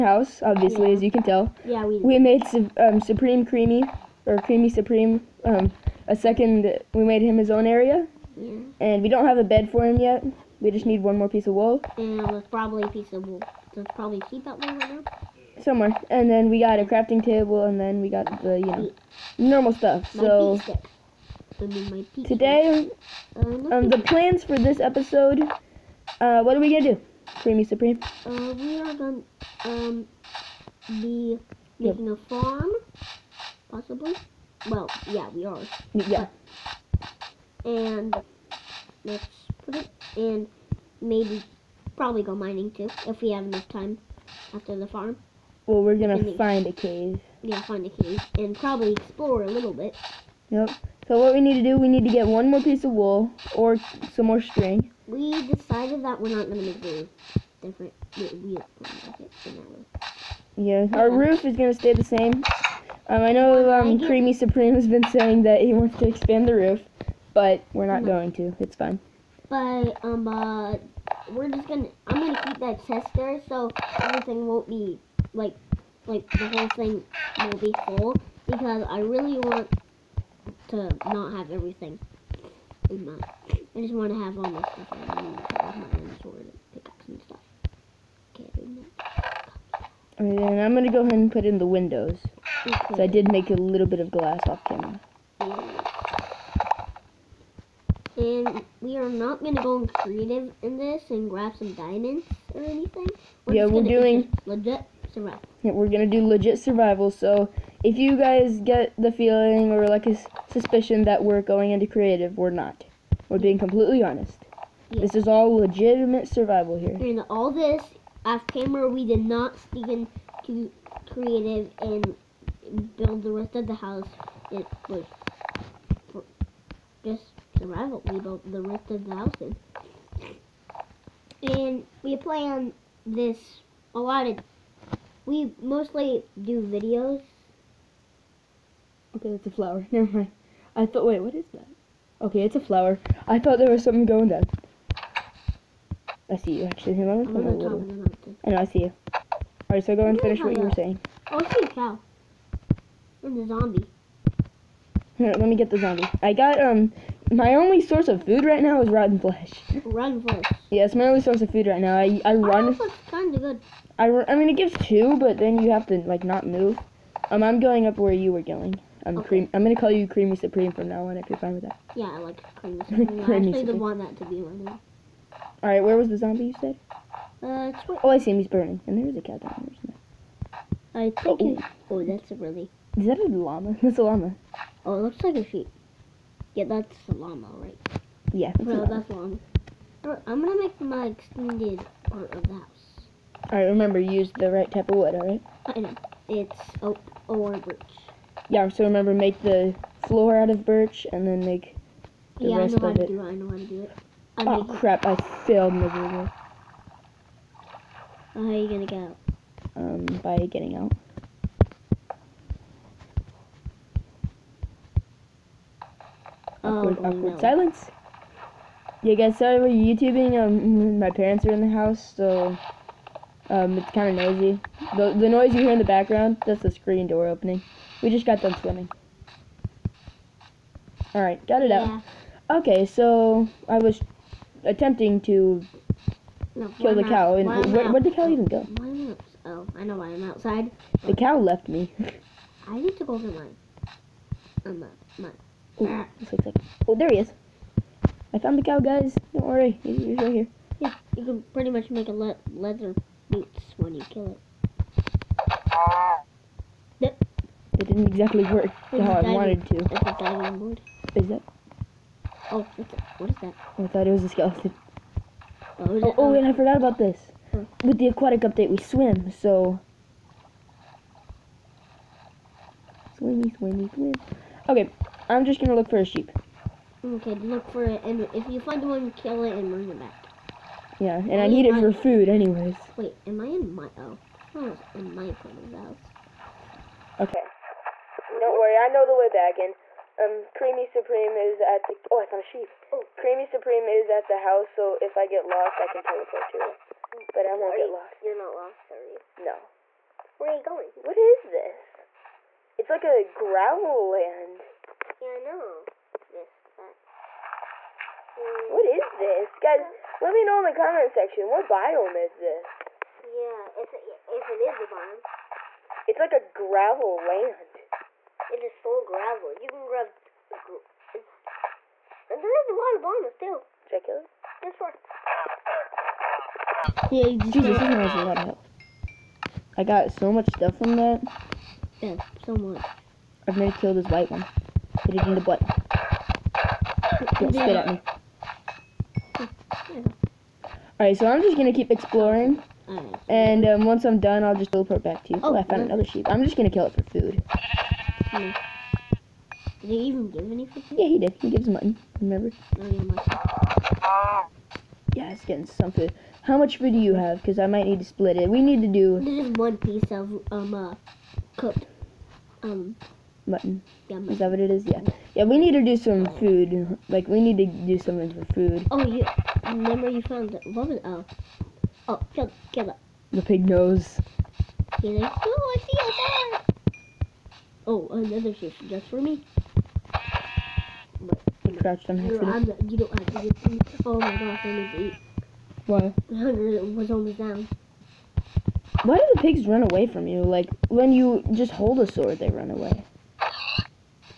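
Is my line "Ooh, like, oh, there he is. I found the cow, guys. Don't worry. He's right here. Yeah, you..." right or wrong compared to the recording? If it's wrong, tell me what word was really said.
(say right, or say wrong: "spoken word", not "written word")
right.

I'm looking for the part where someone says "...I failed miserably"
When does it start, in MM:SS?
03:25.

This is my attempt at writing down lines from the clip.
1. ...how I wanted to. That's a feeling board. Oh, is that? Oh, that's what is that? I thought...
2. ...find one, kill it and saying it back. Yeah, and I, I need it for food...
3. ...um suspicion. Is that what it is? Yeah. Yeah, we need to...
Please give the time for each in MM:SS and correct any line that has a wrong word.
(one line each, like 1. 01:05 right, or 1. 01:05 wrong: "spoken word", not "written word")
1. 04:18 wrong: "diving", not "feeling"
2. 04:38 wrong: "bring", not "saying"
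3. 06:02 wrong: "mutton", not "suspicion".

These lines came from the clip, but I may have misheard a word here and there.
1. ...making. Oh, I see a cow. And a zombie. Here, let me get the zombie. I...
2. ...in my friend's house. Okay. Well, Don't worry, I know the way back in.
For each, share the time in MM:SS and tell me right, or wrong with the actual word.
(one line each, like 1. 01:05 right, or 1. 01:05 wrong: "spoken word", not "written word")
1. 02:30 wrong: "saying", not "making"
2. 04:44 right.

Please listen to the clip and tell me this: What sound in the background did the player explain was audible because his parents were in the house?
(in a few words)
screen door opening.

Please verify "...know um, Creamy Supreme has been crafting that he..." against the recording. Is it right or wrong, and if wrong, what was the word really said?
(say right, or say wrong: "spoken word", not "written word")
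wrong: "saying", not "crafting".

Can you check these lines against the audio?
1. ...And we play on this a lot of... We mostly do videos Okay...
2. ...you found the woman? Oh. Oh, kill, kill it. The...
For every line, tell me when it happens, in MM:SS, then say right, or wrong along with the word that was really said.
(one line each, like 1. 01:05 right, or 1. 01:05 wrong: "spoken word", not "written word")
1. 02:11 right
2. 06:10 right.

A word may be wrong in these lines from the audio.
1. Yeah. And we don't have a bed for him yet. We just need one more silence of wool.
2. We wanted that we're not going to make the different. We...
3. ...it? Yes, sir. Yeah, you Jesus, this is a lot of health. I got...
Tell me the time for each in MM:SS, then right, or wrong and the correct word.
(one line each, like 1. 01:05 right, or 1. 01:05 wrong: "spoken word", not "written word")
1. 00:08 wrong: "piece", not "silence"
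2. 00:55 wrong: "decided", not "wanted"
3. 05:24 right.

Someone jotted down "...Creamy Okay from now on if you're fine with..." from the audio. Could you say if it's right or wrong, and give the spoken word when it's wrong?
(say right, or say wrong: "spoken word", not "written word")
wrong: "Supreme", not "Okay".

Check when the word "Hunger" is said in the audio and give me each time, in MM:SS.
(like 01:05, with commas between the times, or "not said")
06:26.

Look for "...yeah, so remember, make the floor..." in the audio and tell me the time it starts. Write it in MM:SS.
03:18.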